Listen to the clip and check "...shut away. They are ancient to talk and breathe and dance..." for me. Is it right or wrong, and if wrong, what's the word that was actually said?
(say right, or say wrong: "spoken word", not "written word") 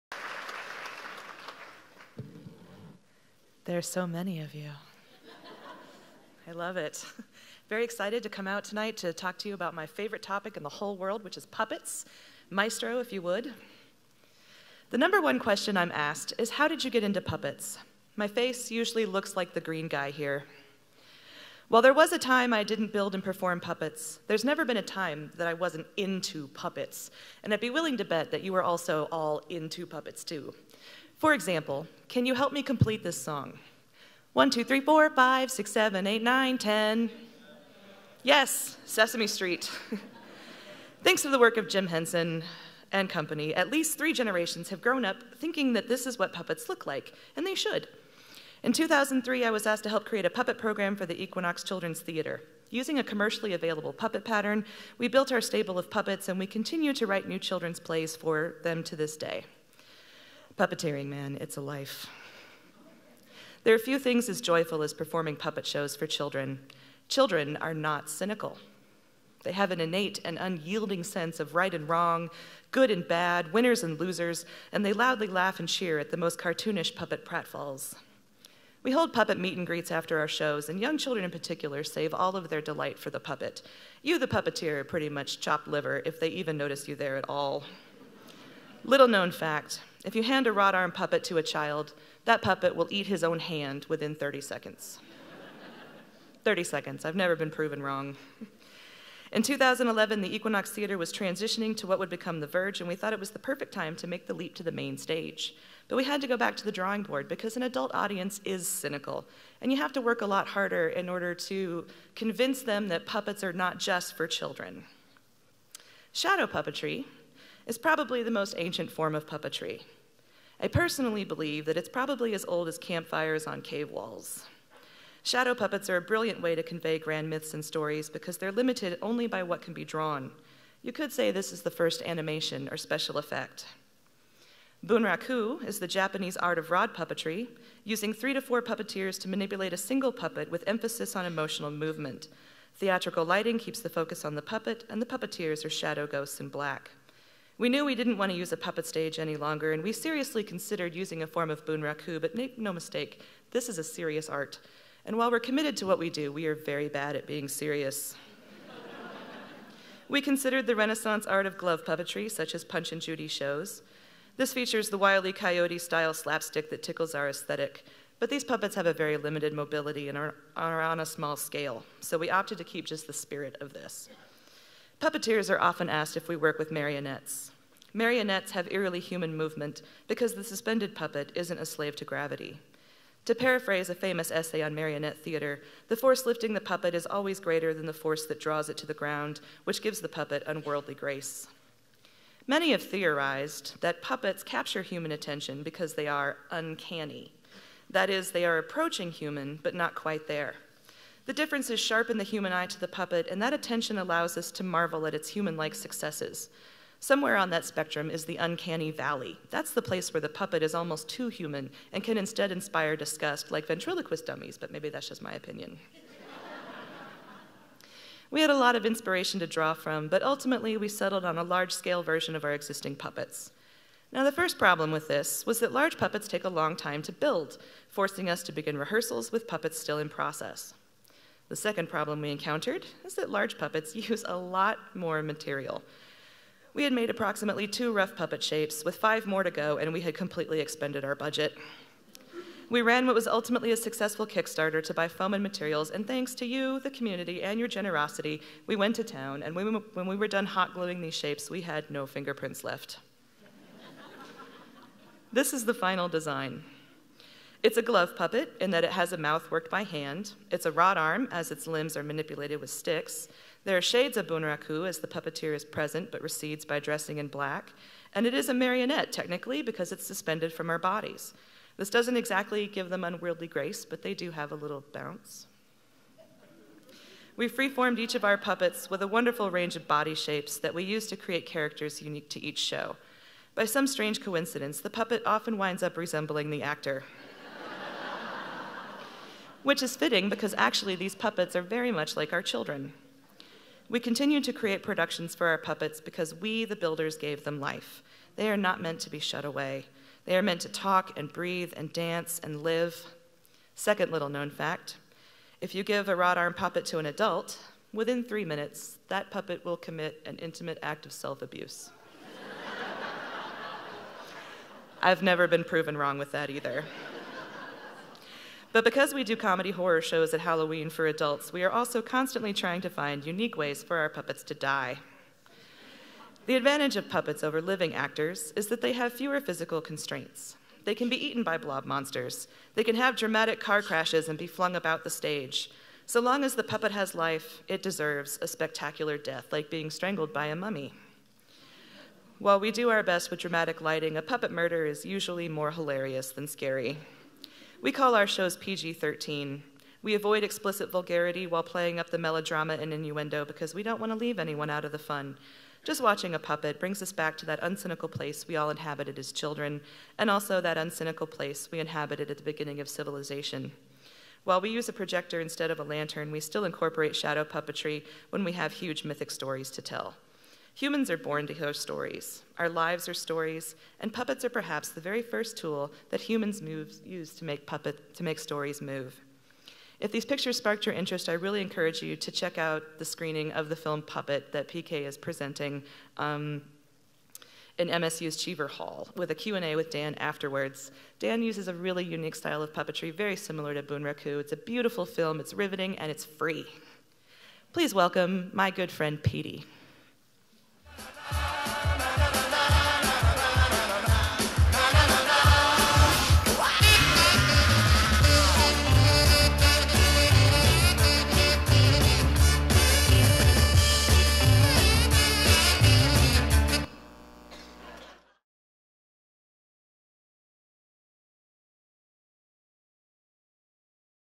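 wrong: "meant", not "ancient".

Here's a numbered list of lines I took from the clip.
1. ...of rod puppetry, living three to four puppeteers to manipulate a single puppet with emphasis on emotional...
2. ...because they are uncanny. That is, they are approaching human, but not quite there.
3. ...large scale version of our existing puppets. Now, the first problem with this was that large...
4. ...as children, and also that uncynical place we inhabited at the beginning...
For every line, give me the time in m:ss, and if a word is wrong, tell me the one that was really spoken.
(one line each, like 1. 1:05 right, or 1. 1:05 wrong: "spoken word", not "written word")
1. 2:16 wrong: "using", not "living"
2. 3:15 right
3. 3:41 right
4. 5:59 right.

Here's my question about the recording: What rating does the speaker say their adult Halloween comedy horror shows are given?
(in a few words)
PG 13.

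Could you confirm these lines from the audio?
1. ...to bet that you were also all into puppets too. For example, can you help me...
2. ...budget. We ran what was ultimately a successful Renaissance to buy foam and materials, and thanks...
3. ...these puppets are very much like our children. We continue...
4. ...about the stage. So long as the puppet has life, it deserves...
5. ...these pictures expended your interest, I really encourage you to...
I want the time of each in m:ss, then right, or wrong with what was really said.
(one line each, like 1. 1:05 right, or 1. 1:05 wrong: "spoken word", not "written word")
1. 0:27 right
2. 4:01 wrong: "Kickstarter", not "Renaissance"
3. 4:50 right
4. 5:34 right
5. 6:20 wrong: "sparked", not "expended".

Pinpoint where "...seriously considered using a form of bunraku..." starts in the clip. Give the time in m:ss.
2:29.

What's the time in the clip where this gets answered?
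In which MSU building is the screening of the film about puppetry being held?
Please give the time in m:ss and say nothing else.
6:28.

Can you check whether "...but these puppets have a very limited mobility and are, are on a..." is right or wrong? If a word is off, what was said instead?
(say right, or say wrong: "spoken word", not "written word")
right.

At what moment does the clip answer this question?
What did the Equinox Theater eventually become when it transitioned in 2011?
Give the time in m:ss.
1:42.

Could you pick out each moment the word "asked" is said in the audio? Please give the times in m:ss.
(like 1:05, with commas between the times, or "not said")
0:15, 0:49, 2:55.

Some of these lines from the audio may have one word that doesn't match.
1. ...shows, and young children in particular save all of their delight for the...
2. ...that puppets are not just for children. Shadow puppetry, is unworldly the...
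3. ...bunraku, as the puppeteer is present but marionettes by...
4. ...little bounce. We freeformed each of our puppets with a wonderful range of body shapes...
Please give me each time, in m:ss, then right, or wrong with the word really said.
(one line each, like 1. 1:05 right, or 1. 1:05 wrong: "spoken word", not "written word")
1. 1:20 right
2. 1:52 wrong: "probably", not "unworldly"
3. 4:24 wrong: "recedes", not "marionettes"
4. 4:34 right.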